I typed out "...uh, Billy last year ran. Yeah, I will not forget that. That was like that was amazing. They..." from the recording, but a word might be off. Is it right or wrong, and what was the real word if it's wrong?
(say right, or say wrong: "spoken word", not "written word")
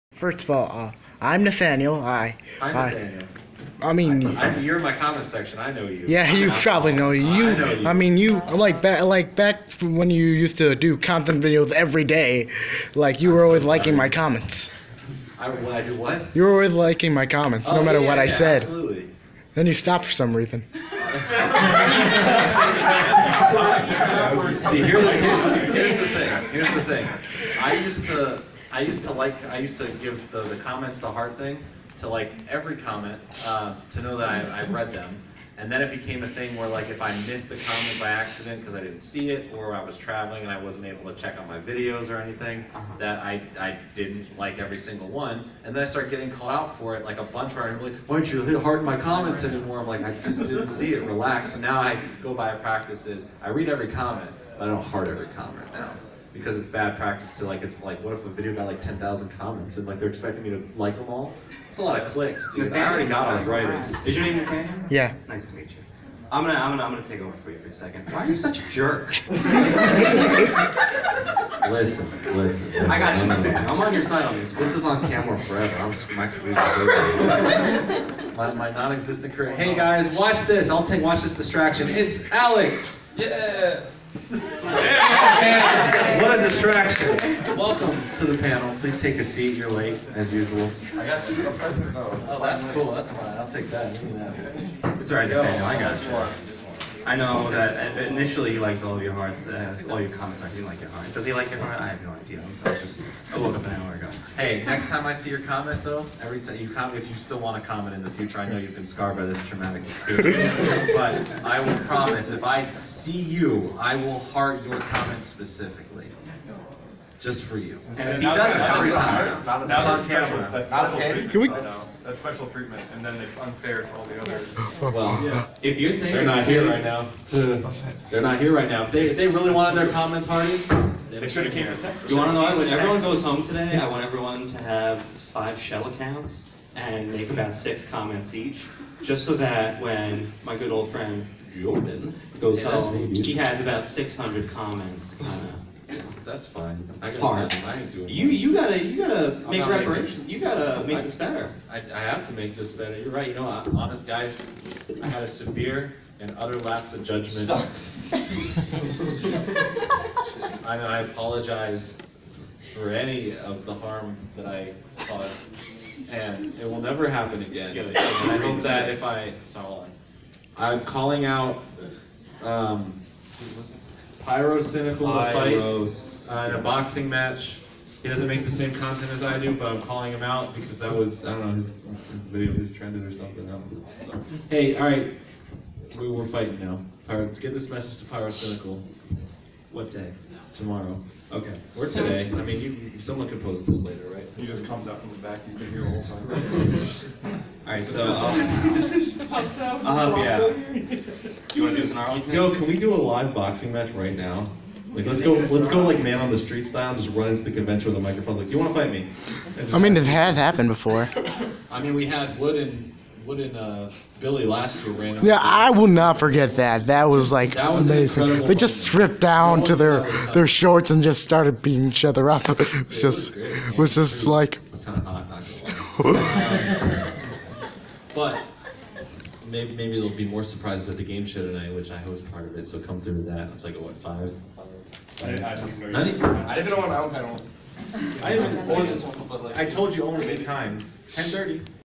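right.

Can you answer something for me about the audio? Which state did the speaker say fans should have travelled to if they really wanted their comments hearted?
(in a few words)
Texas.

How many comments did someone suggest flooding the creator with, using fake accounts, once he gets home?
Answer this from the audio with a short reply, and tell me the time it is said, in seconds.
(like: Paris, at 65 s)
600, at 143 s.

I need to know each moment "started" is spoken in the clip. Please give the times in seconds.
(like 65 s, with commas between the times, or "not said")
45 s, 221 s.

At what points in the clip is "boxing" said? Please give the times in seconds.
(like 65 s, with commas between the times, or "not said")
176 s, 203 s.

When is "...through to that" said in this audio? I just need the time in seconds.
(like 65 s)
233 s.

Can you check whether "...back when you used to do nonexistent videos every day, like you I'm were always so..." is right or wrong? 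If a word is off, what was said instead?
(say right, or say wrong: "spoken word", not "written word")
wrong: "content", not "nonexistent".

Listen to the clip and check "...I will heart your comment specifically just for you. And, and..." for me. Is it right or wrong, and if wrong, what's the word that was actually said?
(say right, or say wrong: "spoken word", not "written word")
right.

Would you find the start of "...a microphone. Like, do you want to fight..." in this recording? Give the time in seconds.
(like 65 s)
207 s.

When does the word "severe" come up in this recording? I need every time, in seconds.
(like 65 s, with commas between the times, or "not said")
155 s.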